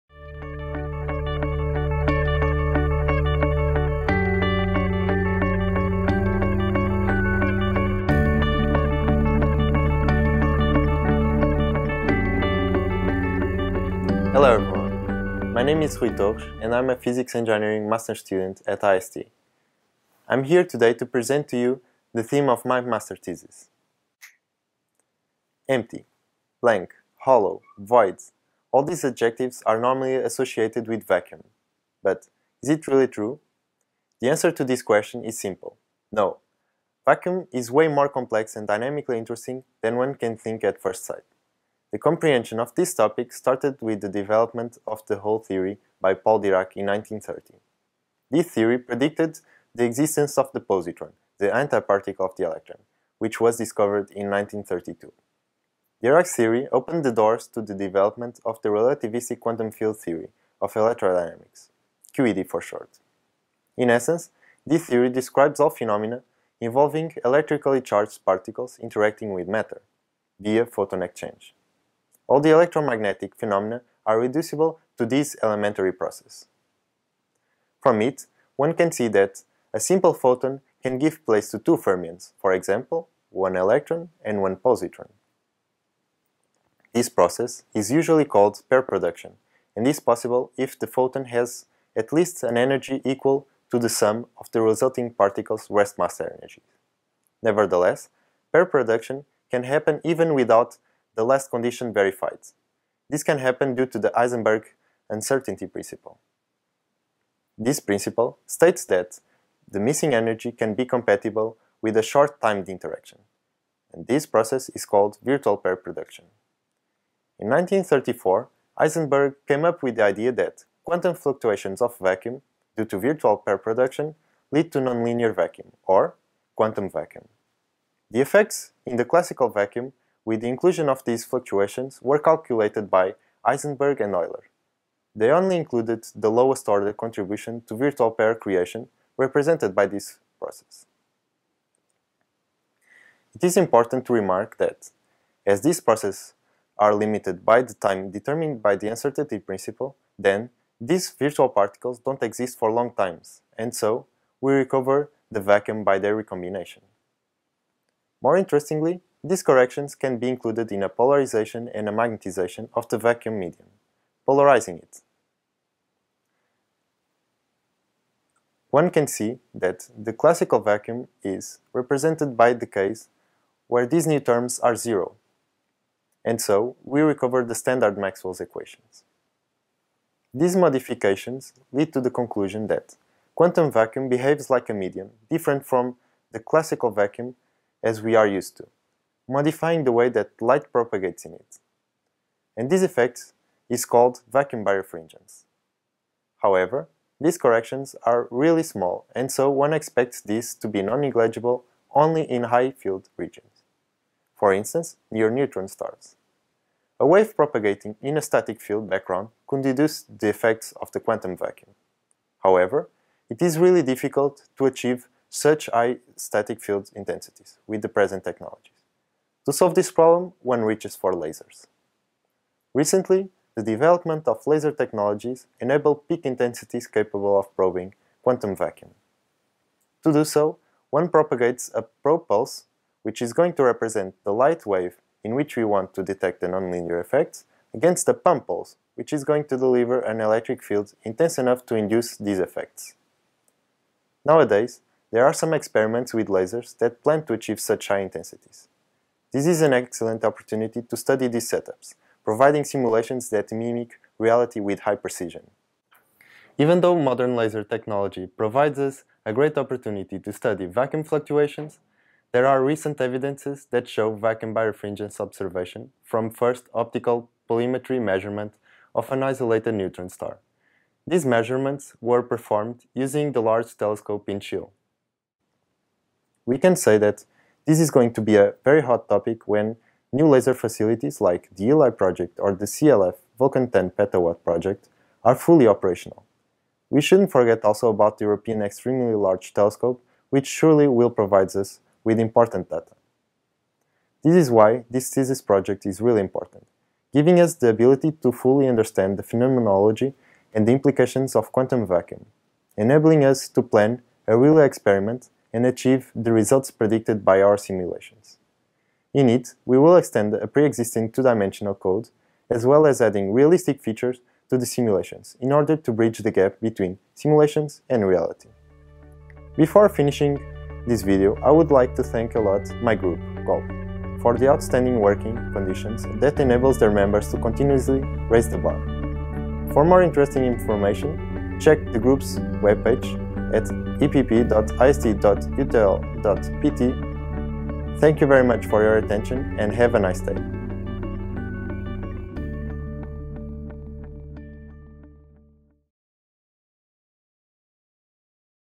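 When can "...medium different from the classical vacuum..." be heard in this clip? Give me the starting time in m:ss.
3:04.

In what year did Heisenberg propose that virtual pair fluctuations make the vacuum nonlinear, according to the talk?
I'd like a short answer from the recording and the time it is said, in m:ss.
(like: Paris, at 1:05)
1934, at 1:57.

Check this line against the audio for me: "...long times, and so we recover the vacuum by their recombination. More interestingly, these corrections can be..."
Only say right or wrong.
right.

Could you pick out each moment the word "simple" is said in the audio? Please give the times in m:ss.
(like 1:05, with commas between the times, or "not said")
0:35, 1:19.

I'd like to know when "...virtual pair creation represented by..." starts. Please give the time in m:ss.
2:17.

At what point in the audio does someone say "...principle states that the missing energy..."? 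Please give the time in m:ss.
1:47.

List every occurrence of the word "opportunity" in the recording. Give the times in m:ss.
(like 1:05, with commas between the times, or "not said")
4:10, 4:19.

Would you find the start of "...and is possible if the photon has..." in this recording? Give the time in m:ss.
1:29.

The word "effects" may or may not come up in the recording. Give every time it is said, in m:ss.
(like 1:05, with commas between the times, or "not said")
2:08, 3:12, 3:30, 3:57, 4:02.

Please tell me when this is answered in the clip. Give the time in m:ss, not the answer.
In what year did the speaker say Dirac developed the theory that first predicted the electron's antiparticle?
0:46.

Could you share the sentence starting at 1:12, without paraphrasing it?
All the electromagnetic phenomena are reducible to this elementary process.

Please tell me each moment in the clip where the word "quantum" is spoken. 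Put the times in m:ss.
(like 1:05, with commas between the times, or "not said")
0:59, 2:00, 2:06, 3:03, 3:30, 3:48, 5:01.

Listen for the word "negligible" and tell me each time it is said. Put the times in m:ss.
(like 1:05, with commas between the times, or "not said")
3:20.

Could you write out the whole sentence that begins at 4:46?
We shouldn't forget also about the European Extremely Large Telescope, which surely will provide us with important data.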